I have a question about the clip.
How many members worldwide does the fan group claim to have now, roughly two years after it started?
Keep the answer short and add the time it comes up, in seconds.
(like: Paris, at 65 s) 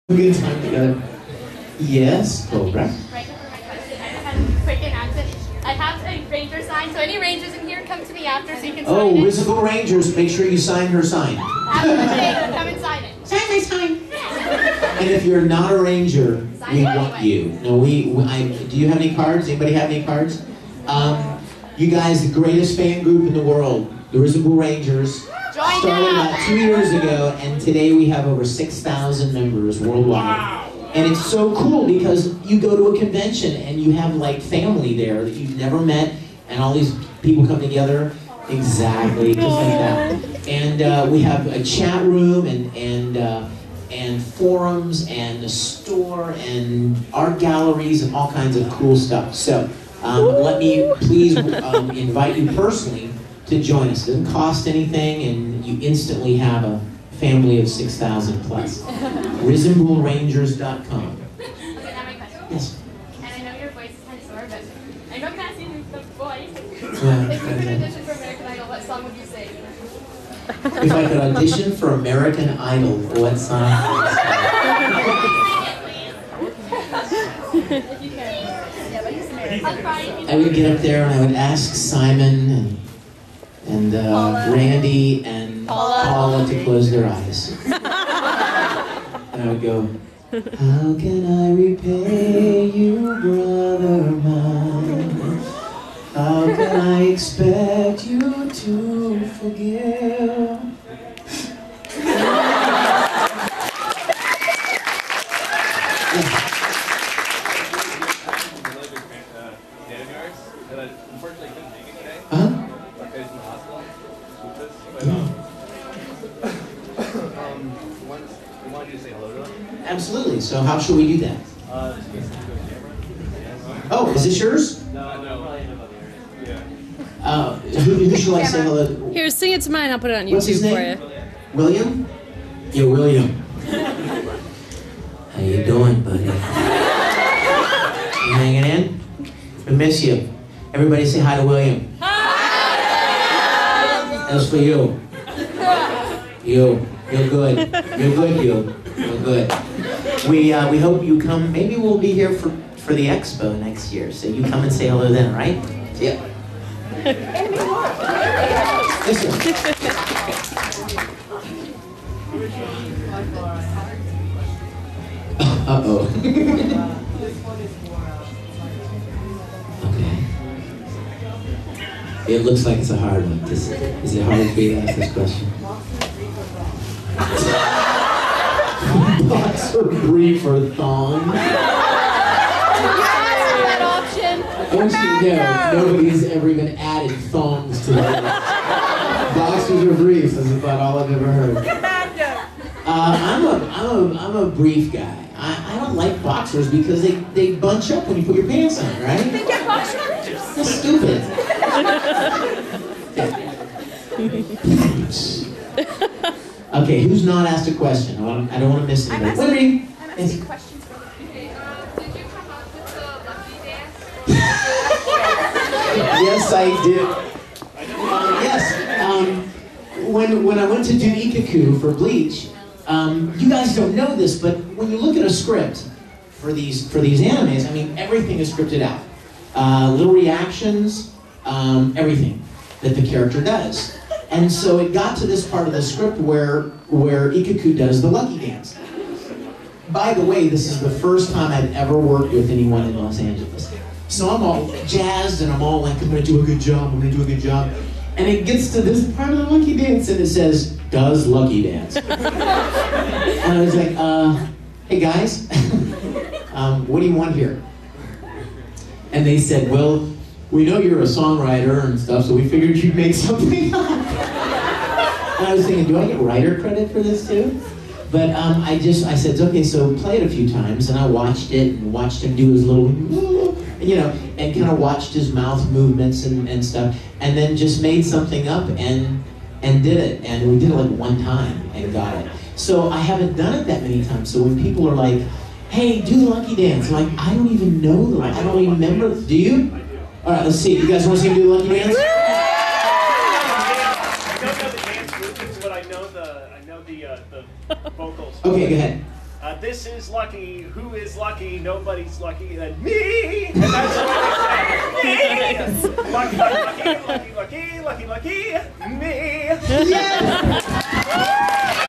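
over 6,000, at 28 s.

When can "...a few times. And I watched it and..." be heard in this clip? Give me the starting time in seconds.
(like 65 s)
270 s.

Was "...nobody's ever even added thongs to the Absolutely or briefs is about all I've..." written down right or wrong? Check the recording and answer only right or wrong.
wrong.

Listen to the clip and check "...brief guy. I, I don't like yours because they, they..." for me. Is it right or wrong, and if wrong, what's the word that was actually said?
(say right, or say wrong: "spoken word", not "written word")
wrong: "boxers", not "yours".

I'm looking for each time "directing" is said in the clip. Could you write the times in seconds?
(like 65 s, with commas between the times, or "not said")
not said.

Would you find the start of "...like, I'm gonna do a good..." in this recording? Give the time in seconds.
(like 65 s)
245 s.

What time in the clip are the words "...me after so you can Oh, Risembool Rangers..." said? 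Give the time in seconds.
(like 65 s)
8 s.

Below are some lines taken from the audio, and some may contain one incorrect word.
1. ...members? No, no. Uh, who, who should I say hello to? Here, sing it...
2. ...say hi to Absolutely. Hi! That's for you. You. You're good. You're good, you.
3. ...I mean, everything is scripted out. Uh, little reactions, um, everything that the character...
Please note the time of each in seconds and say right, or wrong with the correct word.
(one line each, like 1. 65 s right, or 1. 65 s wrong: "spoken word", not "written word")
1. 124 s wrong: "yours", not "members"
2. 141 s wrong: "William", not "Absolutely"
3. 227 s right.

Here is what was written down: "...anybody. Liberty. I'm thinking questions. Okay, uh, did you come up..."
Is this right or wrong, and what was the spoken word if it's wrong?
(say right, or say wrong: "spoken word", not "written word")
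wrong: "asking", not "thinking".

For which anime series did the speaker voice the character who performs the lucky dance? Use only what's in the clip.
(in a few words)
Bleach.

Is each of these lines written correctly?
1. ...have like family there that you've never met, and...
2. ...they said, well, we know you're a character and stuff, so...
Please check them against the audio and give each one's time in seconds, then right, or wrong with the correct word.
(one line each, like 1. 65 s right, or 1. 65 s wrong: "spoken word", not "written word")
1. 33 s right
2. 259 s wrong: "songwriter", not "character".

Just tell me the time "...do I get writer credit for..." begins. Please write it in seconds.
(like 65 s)
265 s.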